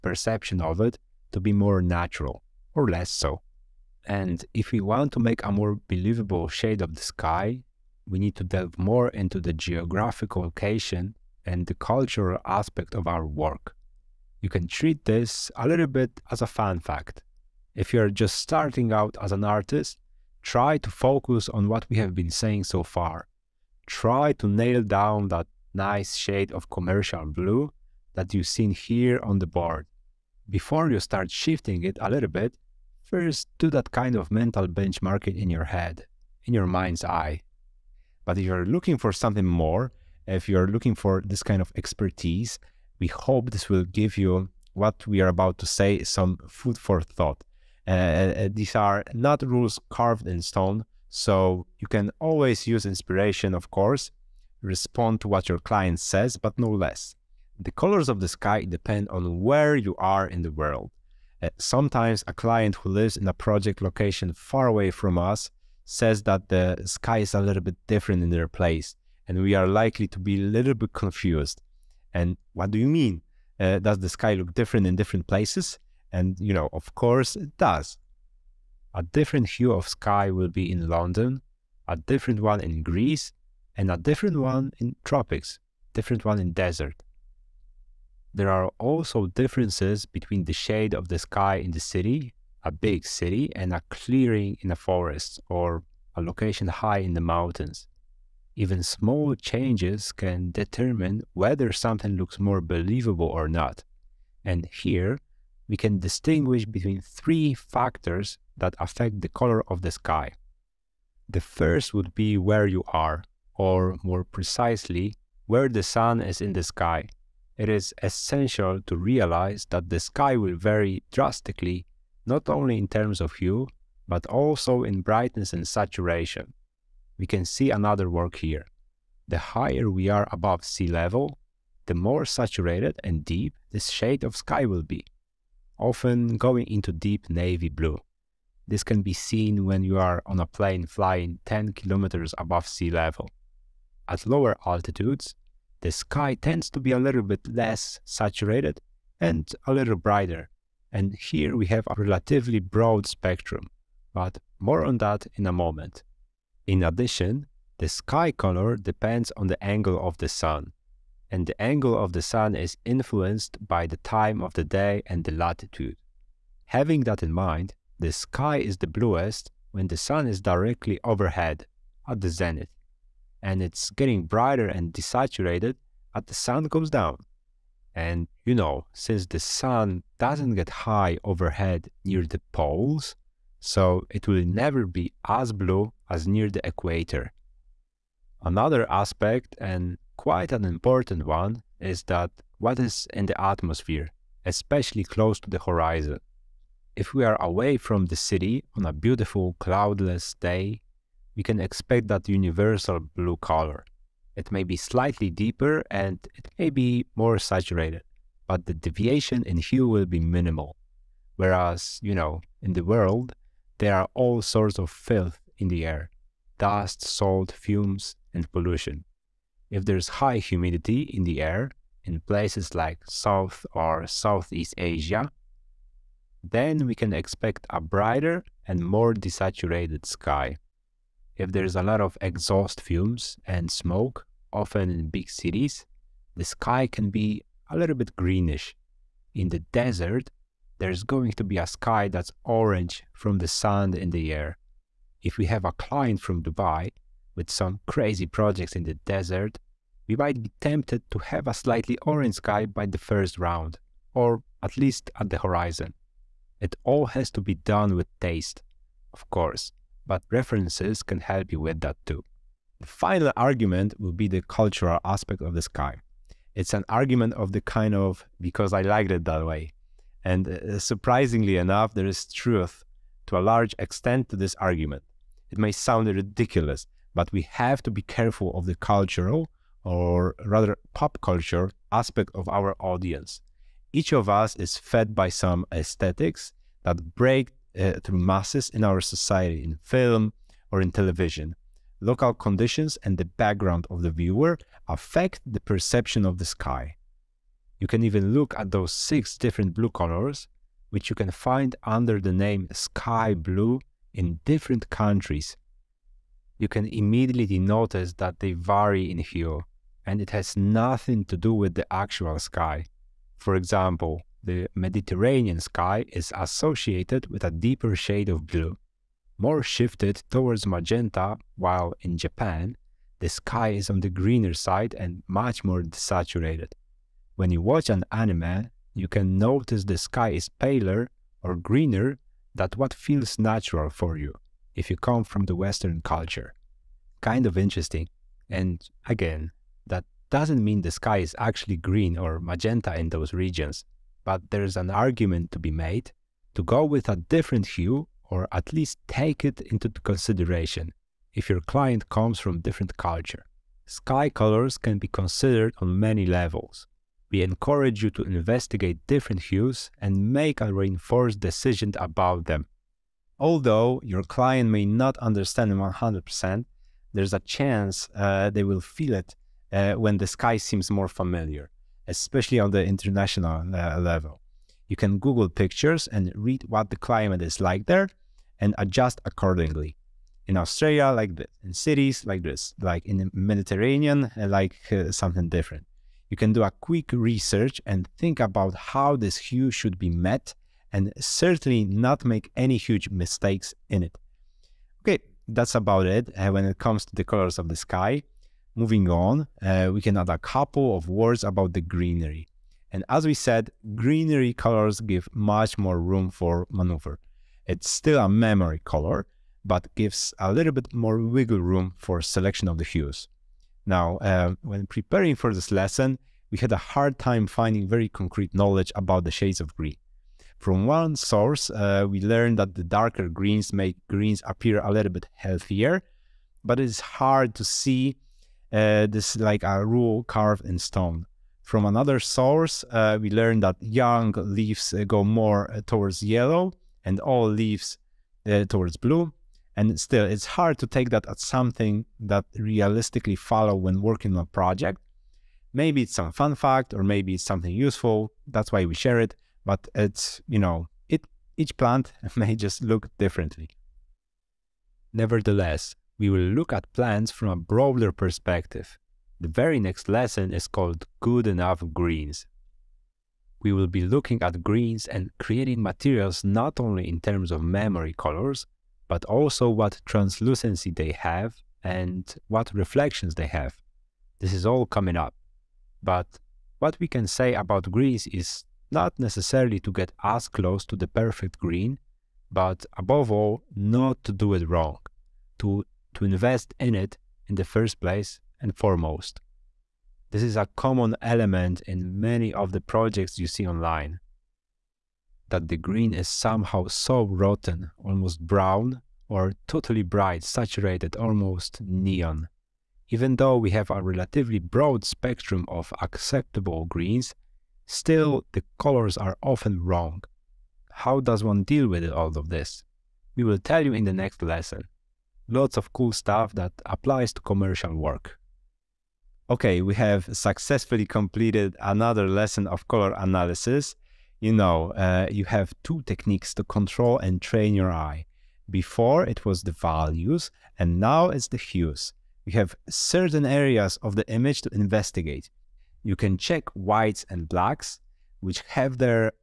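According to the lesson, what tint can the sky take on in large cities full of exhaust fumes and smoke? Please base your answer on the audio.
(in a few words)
greenish.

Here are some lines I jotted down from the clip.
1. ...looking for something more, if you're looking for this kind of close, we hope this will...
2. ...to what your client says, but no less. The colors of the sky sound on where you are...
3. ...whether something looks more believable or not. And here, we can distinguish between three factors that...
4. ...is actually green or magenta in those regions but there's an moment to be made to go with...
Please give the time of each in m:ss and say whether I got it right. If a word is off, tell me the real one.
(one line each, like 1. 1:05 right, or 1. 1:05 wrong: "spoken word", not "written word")
1. 0:38 wrong: "expertise", not "close"
2. 0:55 wrong: "depend", not "sound"
3. 1:41 right
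4. 5:41 wrong: "argument", not "moment".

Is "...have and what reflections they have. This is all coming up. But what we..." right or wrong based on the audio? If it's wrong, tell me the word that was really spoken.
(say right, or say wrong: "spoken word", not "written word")
right.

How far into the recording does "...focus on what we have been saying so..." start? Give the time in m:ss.
0:20.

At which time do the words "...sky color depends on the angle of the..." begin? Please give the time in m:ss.
2:37.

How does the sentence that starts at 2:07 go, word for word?
We can see another work here.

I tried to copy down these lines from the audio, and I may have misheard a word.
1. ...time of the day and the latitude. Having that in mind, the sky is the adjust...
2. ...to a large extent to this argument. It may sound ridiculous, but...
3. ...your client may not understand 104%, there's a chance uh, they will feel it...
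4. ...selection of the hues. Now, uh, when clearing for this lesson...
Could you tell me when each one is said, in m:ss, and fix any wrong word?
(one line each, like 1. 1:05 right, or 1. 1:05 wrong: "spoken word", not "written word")
1. 2:44 wrong: "bluest", not "adjust"
2. 4:33 right
3. 6:04 wrong: "100", not "104"
4. 6:52 wrong: "preparing", not "clearing".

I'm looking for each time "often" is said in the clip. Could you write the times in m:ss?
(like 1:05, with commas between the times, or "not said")
2:15, 3:54, 8:29.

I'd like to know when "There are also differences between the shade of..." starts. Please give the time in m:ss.
1:28.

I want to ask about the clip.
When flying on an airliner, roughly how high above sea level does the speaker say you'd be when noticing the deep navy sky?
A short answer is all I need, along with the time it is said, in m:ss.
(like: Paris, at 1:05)
10 kilometers, at 2:21.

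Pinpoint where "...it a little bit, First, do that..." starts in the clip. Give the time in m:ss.
0:31.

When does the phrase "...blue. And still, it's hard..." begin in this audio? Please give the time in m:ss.
7:18.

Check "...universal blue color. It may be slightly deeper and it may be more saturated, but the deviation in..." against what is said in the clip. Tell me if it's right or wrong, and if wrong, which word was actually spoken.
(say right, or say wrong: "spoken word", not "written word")
right.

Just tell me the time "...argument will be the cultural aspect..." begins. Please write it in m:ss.
4:23.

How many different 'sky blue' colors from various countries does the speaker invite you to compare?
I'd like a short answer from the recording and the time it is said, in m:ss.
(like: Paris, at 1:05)
6, at 4:58.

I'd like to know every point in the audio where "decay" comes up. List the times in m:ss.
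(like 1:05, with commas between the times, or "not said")
not said.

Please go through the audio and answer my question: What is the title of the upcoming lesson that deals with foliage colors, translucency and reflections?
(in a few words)
Good Enough Greens.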